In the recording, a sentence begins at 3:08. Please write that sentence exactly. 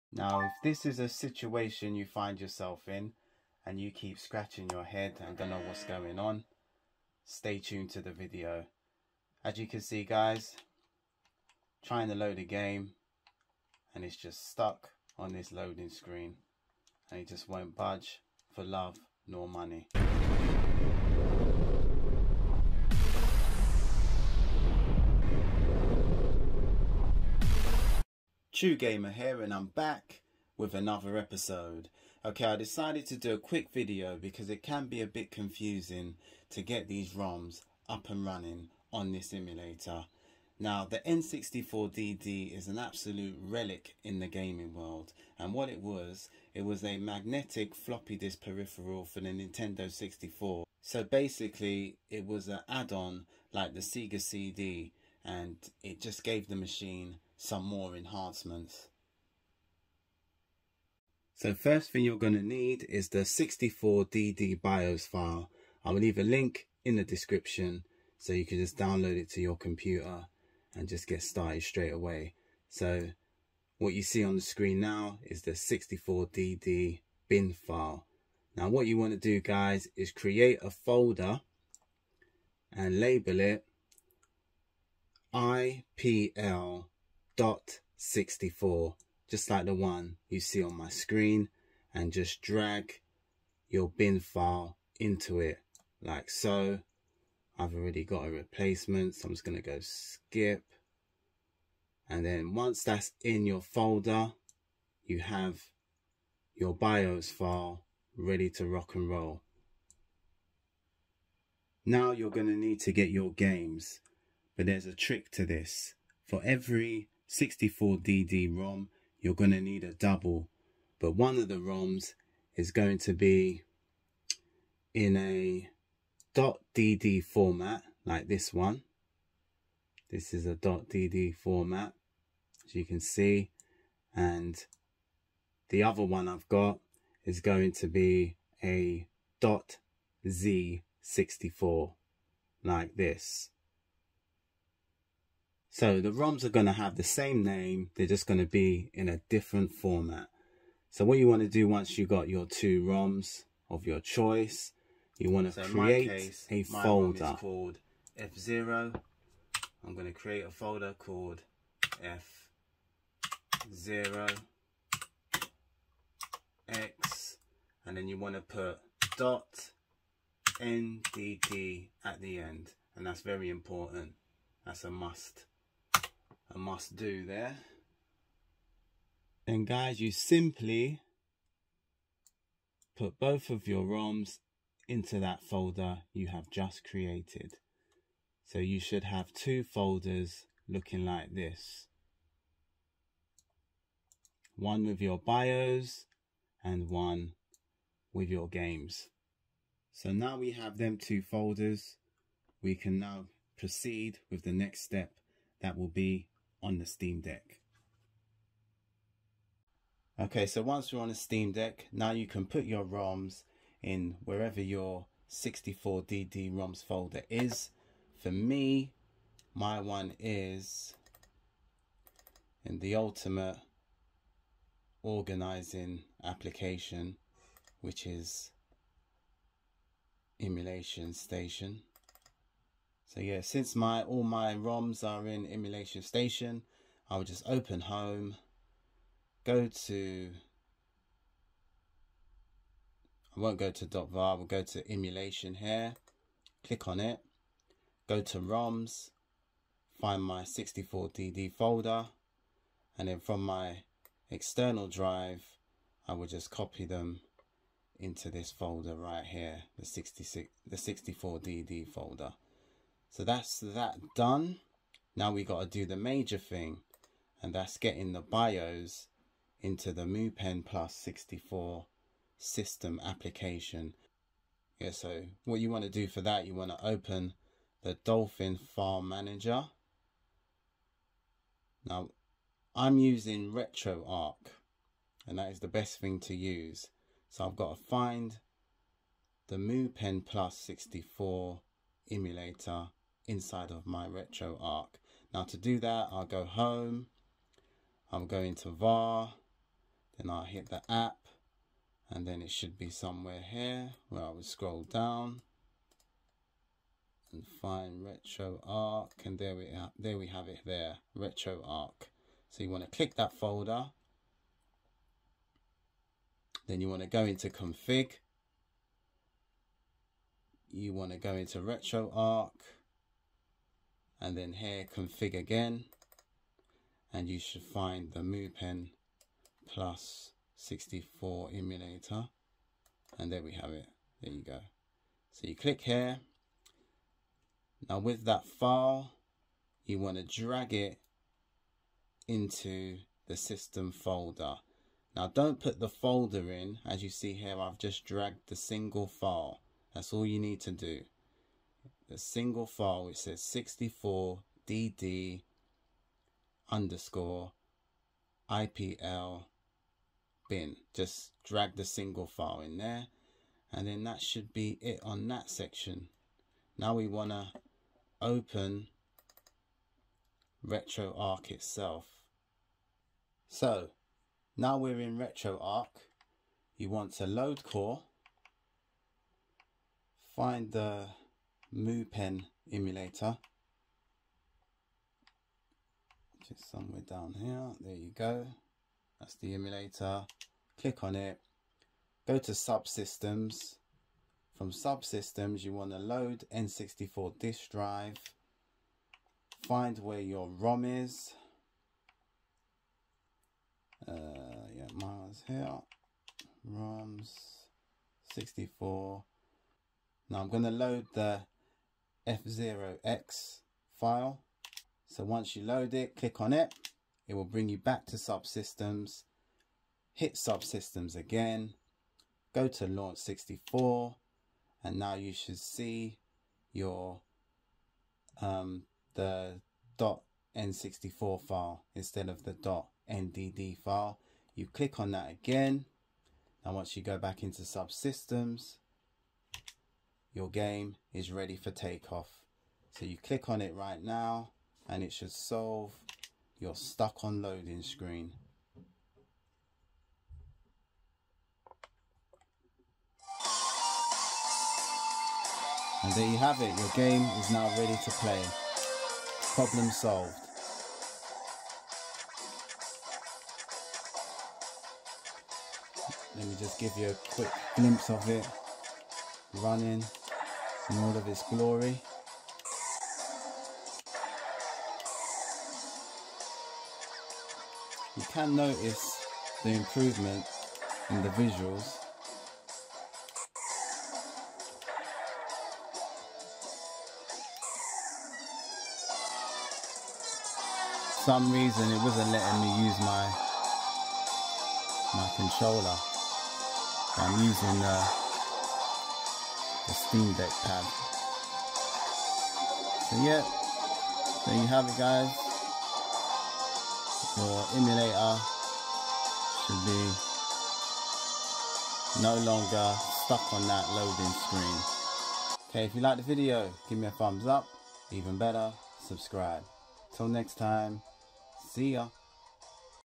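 So you should have two folders looking like this.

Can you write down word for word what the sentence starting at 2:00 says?
But one of the ROMs is going to be in a .dd format, like this one.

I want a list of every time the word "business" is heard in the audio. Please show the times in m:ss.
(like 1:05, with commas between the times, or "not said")
not said.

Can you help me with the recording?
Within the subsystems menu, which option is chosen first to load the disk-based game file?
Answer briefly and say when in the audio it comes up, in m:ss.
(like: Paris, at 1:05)
N64 disk drive, at 6:36.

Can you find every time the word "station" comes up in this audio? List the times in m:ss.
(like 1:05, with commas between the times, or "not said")
3:51, 3:56.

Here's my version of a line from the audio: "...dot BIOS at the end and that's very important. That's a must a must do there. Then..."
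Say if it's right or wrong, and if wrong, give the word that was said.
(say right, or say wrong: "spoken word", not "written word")
wrong: "NDD", not "BIOS".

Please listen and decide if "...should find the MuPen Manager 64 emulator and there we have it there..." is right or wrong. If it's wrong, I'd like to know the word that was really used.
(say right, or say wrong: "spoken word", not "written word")
wrong: "Plus", not "Manager".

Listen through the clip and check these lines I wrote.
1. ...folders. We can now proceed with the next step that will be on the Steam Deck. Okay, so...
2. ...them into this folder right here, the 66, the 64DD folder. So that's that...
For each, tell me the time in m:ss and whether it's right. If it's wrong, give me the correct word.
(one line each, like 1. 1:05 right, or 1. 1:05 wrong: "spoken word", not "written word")
1. 3:21 right
2. 4:16 right.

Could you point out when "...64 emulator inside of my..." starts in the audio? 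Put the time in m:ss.
4:50.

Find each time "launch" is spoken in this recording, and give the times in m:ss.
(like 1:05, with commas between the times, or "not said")
7:02.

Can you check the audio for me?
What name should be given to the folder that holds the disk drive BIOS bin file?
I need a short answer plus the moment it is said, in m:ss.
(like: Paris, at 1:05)
IPL.64, at 1:25.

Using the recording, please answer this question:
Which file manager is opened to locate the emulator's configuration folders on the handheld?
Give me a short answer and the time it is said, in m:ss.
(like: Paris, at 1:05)
Dolphin, at 4:38.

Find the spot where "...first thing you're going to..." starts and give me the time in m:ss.
1:01.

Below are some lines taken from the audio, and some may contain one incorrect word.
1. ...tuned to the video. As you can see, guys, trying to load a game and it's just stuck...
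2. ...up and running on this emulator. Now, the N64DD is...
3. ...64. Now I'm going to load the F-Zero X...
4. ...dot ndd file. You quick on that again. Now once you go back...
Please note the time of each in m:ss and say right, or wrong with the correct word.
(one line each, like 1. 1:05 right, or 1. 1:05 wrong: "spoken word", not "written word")
1. 0:07 right
2. 0:37 right
3. 6:48 right
4. 7:12 wrong: "click", not "quick".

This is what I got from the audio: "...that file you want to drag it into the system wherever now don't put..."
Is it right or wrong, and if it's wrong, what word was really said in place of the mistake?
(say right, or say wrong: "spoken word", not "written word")
wrong: "folder", not "wherever".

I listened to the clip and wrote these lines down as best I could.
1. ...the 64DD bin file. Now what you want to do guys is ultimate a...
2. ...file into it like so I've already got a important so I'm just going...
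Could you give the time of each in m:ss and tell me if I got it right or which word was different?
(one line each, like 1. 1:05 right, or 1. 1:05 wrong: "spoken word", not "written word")
1. 1:15 wrong: "create", not "ultimate"
2. 1:34 wrong: "replacement", not "important".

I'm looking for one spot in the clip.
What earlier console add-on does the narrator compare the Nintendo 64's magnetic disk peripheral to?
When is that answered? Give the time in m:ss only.
0:53.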